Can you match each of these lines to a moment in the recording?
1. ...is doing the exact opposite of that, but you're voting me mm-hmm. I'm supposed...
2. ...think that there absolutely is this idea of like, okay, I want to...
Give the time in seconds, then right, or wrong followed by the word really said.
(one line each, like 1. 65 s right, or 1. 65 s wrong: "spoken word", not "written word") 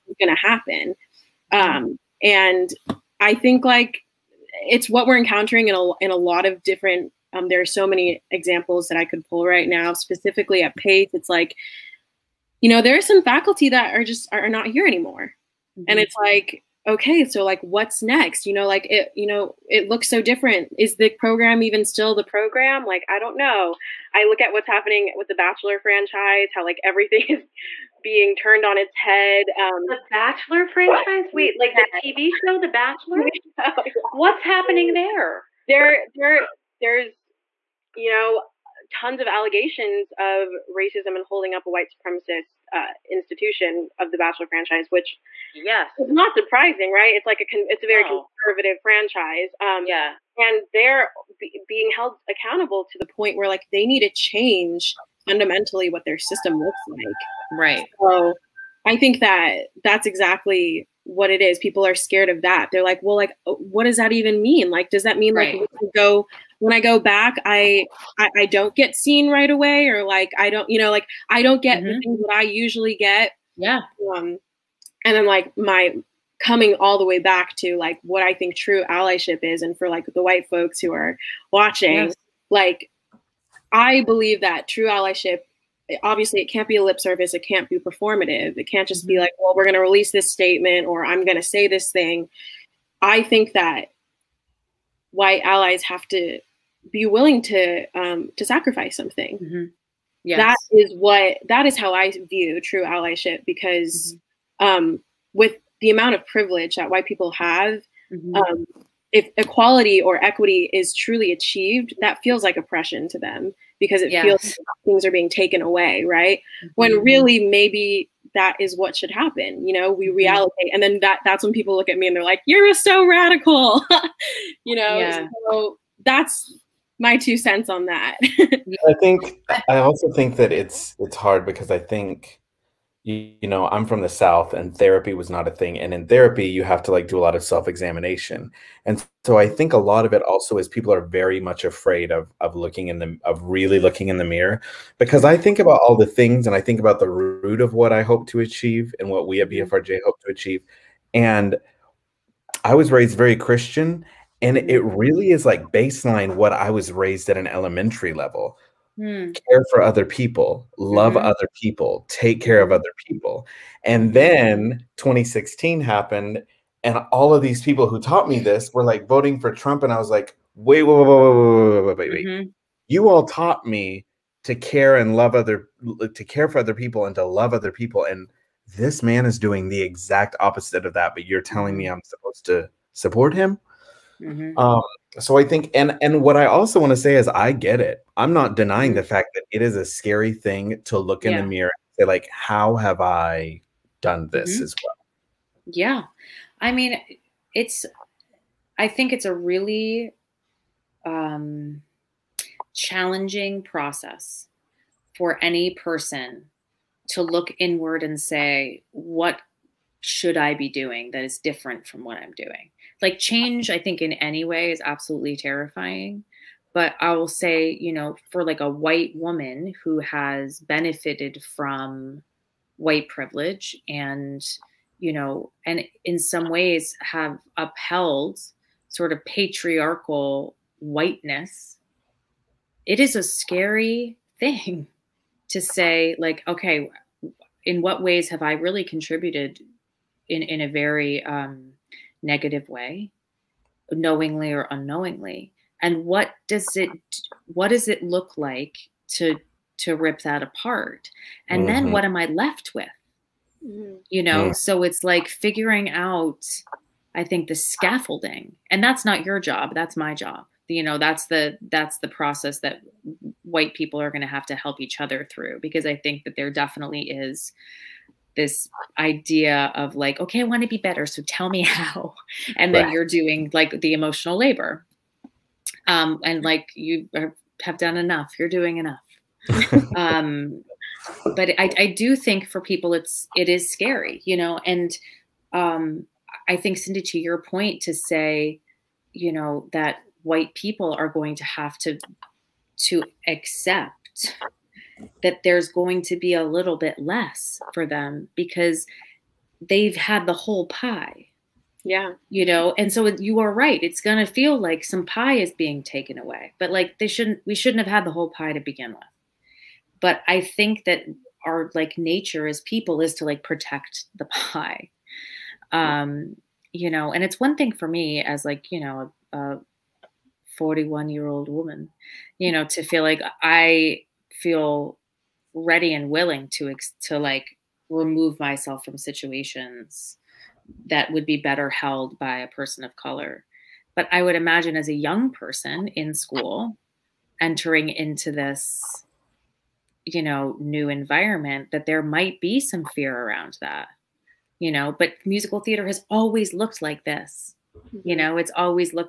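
1. 179 s wrong: "telling", not "voting"
2. 265 s wrong: "definitely", not "absolutely".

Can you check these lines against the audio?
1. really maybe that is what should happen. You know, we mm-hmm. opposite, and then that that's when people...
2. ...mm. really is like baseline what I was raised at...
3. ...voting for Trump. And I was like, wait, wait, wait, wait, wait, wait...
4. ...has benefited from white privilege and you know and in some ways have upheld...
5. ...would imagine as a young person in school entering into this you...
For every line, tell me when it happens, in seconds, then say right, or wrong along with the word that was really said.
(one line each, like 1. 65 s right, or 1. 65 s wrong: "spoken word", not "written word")
1. 117 s wrong: "reallocate", not "opposite"
2. 154 s right
3. 169 s right
4. 219 s right
5. 334 s right.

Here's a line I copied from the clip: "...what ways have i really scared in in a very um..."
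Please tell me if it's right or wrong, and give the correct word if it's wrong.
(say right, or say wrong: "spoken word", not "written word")
wrong: "contributed", not "scared".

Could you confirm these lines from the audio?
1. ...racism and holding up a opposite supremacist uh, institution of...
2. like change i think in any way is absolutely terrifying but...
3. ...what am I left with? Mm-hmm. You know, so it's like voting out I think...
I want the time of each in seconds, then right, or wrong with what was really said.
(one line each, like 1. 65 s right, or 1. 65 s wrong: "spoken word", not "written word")
1. 40 s wrong: "white", not "opposite"
2. 213 s right
3. 251 s wrong: "figuring", not "voting".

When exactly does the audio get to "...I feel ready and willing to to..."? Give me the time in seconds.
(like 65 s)
323 s.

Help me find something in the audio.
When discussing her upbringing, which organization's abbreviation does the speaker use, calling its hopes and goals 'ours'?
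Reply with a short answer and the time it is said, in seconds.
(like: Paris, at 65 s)
BFRJ, at 149 s.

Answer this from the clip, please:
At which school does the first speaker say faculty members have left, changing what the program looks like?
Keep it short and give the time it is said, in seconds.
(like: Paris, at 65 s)
Pace, at 10 s.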